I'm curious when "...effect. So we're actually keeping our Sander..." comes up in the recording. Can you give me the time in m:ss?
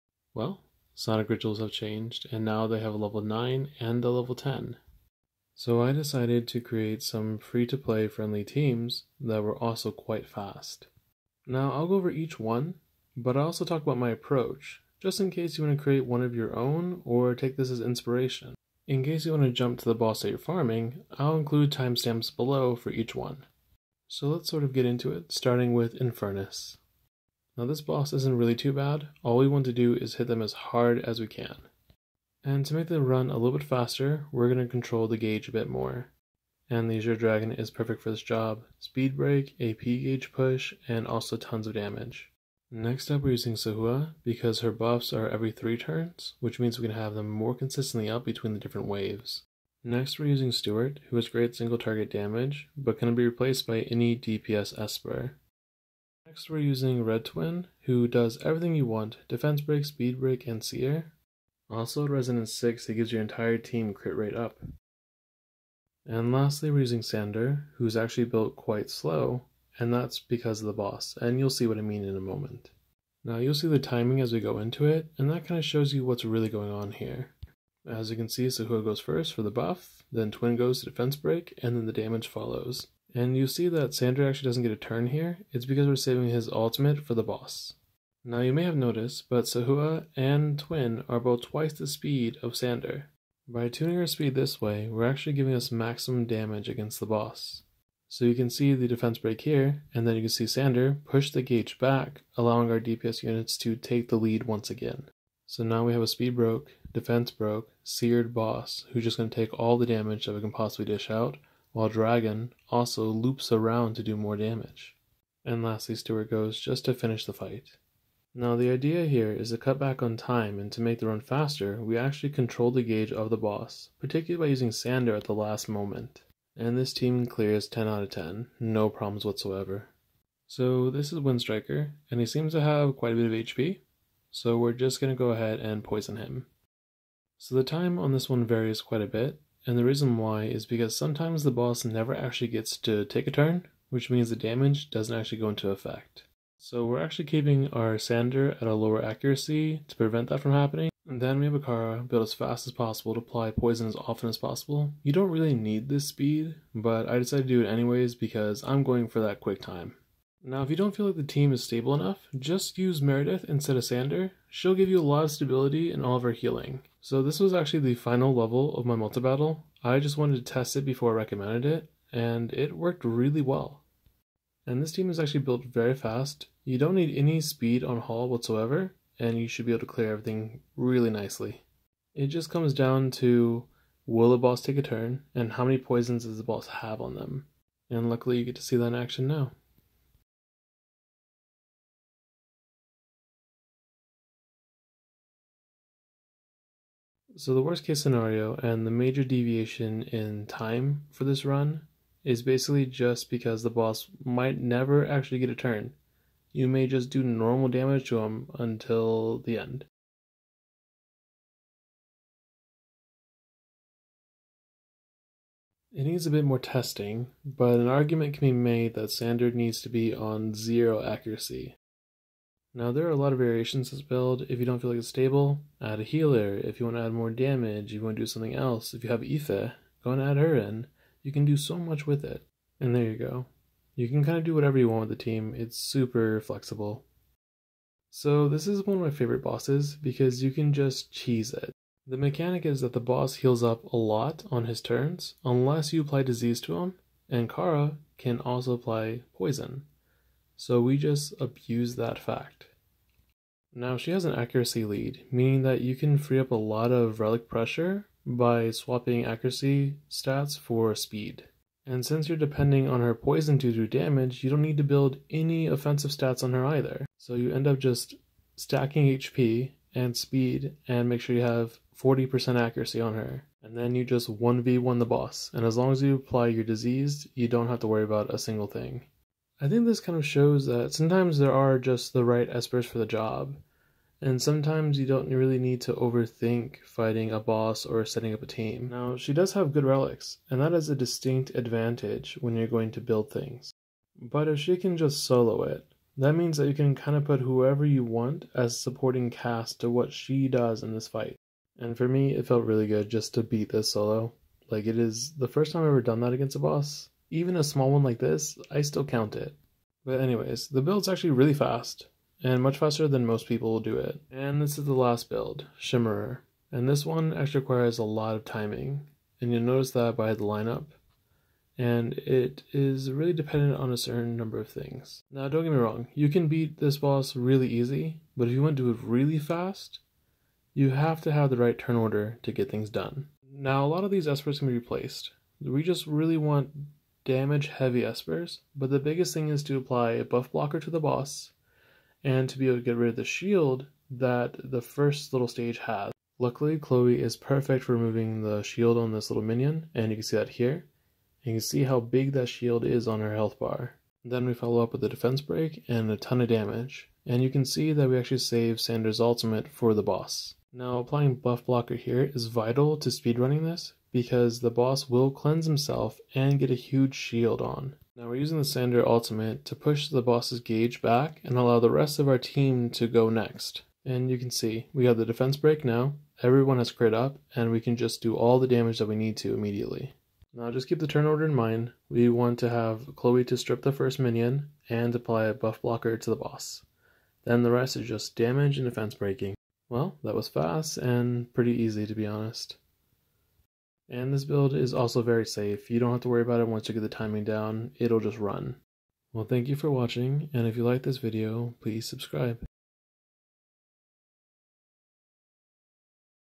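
2:25.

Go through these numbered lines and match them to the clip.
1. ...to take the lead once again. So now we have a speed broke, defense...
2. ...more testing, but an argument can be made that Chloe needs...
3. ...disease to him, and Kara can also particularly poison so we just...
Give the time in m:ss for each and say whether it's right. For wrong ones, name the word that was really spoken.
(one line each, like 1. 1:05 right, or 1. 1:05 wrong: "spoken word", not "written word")
1. 1:43 right
2. 3:36 wrong: "Sander", not "Chloe"
3. 4:06 wrong: "apply", not "particularly".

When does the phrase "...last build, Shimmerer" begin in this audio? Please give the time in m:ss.
5:14.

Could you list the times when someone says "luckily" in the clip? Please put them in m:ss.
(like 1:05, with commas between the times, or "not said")
3:08, 5:46.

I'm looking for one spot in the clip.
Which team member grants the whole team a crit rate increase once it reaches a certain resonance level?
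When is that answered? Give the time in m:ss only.
0:57.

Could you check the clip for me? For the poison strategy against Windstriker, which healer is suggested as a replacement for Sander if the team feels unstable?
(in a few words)
Meredith.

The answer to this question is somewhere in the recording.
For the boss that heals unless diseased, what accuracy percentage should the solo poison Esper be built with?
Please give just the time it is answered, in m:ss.
4:31.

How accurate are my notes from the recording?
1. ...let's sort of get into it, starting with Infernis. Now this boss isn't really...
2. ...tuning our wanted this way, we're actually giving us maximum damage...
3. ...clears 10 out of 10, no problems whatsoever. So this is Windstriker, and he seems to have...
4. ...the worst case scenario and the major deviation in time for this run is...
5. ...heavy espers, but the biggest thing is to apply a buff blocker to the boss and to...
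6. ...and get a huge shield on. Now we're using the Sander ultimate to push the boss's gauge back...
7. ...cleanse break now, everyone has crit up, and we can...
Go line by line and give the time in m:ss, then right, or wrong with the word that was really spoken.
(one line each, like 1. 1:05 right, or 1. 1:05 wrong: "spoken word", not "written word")
1. 0:24 right
2. 1:33 wrong: "speed", not "wanted"
3. 2:07 right
4. 3:17 right
5. 5:37 right
6. 6:06 right
7. 6:15 wrong: "defense", not "cleanse".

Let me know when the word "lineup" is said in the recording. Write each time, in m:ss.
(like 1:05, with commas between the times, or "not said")
5:20.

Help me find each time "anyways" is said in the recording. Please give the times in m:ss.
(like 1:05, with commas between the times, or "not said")
2:37, 5:10.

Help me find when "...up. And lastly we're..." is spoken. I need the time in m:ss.
1:04.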